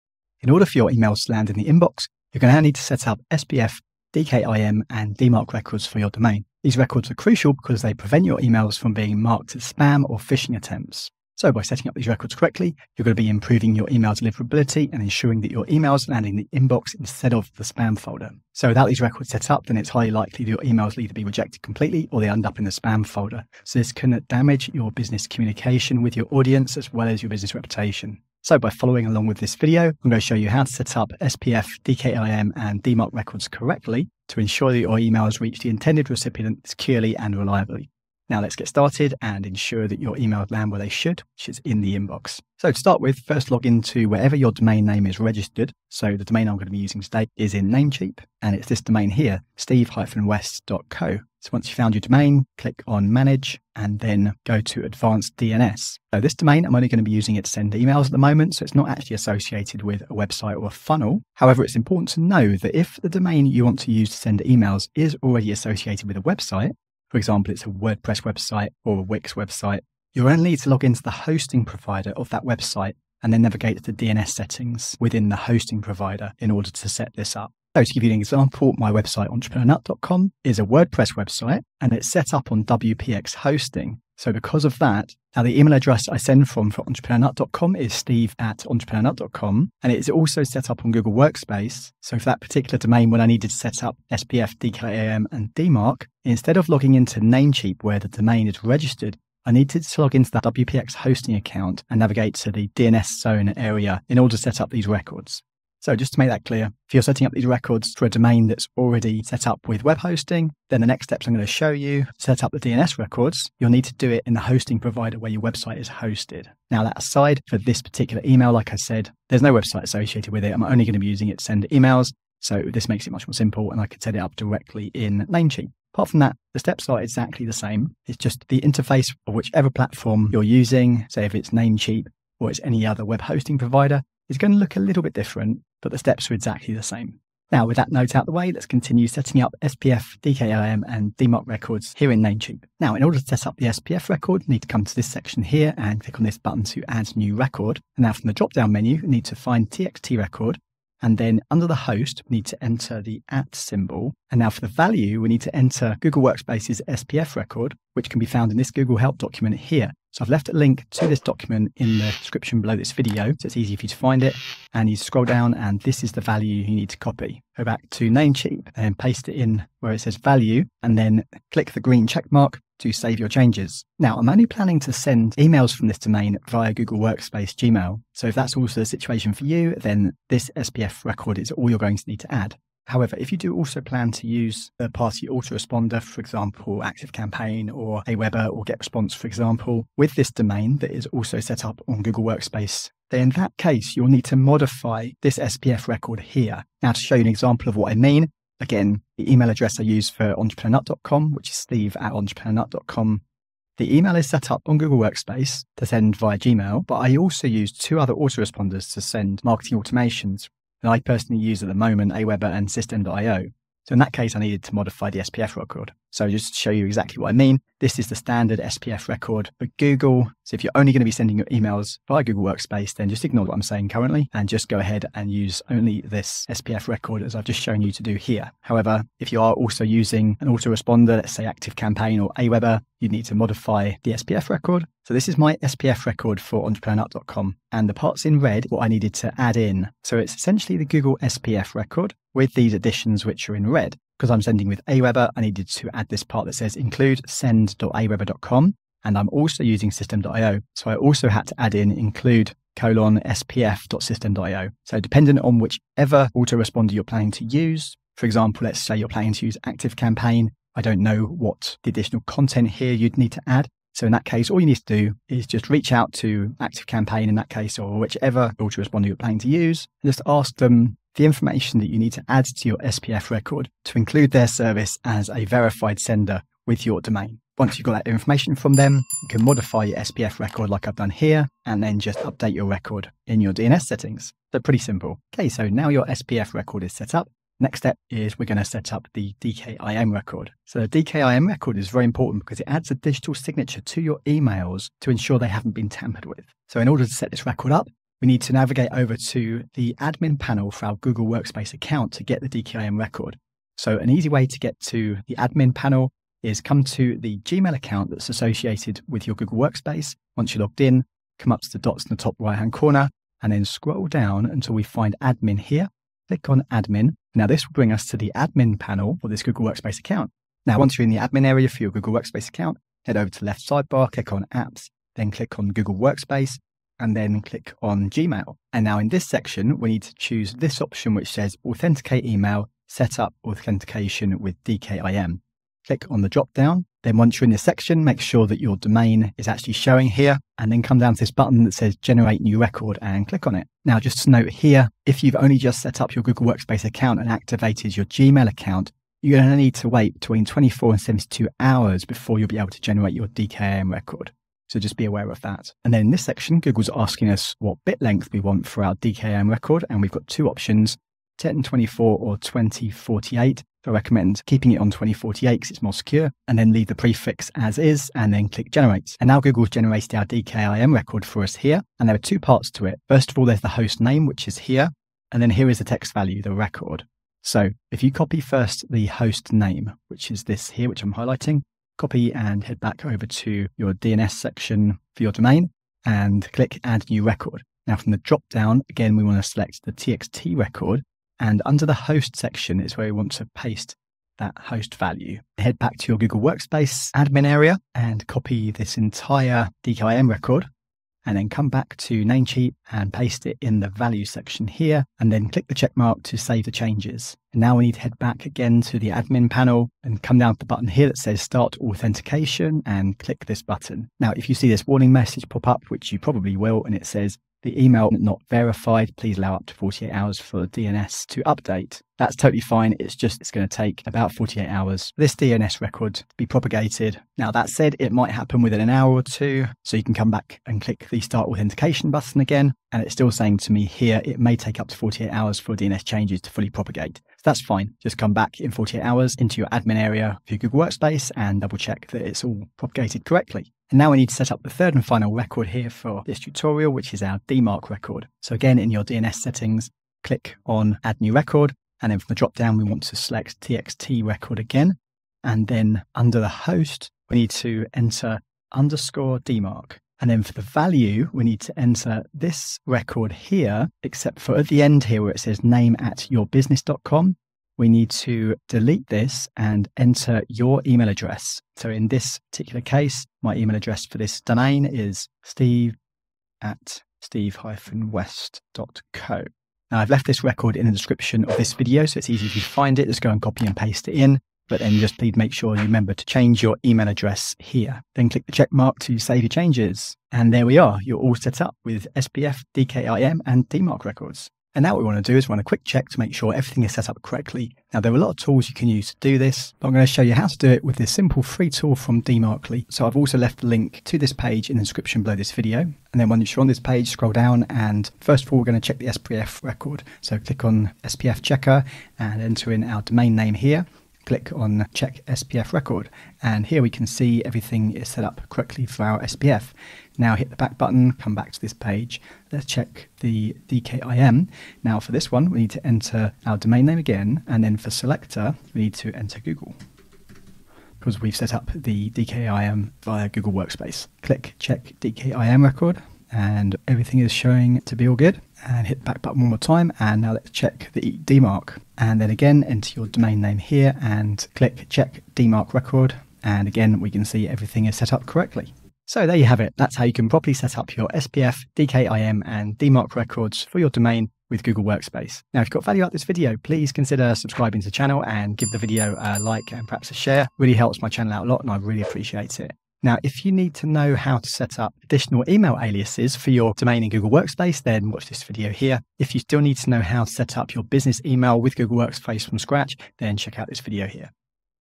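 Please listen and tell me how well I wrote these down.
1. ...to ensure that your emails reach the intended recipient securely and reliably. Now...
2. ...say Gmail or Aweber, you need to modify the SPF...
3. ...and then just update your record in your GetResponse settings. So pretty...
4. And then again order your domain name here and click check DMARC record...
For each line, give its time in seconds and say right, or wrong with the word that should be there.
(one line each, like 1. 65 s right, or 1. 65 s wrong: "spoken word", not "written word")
1. 34 s right
2. 231 s wrong: "ActiveCampaign", not "Gmail"
3. 281 s wrong: "DNS", not "GetResponse"
4. 541 s wrong: "enter", not "order".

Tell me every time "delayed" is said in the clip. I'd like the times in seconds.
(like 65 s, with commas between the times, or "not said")
not said.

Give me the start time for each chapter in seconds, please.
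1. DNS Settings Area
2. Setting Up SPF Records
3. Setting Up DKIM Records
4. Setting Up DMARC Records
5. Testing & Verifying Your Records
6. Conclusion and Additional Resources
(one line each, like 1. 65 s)
1. 42 s
2. 143 s
3. 287 s
4. 444 s
5. 494 s
6. 550 s.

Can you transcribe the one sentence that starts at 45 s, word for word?
So the domain I'm going to be using today is in Namecheap, and it's this domain here, steve-west.co.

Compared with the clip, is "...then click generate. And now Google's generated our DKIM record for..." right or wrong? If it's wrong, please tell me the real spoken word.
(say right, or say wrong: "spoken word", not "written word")
right.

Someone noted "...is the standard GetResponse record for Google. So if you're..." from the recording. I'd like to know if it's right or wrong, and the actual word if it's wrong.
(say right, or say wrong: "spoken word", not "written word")
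wrong: "SPF", not "GetResponse".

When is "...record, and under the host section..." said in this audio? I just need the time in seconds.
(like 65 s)
390 s.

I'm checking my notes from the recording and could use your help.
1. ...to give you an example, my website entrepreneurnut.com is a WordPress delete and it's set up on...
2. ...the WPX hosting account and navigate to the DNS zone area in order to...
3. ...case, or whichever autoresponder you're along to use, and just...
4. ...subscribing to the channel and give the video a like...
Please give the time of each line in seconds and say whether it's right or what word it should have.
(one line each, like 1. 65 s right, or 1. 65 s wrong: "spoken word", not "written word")
1. 77 s wrong: "website", not "delete"
2. 100 s right
3. 267 s wrong: "planning", not "along"
4. 557 s right.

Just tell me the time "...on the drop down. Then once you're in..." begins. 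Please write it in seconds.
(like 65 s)
336 s.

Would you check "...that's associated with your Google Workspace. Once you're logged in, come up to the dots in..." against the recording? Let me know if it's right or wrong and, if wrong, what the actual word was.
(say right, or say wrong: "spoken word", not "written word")
right.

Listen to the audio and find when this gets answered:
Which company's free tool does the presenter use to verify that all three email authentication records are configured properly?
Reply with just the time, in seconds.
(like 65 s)
502 s.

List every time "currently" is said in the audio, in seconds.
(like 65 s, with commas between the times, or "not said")
223 s.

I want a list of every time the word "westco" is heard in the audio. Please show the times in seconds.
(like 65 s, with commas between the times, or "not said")
49 s, 477 s.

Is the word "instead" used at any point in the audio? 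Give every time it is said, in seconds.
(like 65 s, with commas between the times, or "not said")
16 s, 96 s.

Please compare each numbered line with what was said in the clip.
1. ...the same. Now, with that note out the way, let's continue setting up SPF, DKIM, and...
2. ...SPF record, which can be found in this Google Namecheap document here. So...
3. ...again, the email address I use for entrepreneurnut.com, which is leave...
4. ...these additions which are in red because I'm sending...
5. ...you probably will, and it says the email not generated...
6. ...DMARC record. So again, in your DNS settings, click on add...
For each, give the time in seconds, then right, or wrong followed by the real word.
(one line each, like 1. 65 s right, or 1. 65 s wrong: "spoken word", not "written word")
1. 136 s right
2. 156 s wrong: "Help", not "Namecheap"
3. 198 s wrong: "steve", not "leave"
4. 242 s right
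5. 416 s wrong: "verified", not "generated"
6. 447 s right.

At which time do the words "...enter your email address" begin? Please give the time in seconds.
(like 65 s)
469 s.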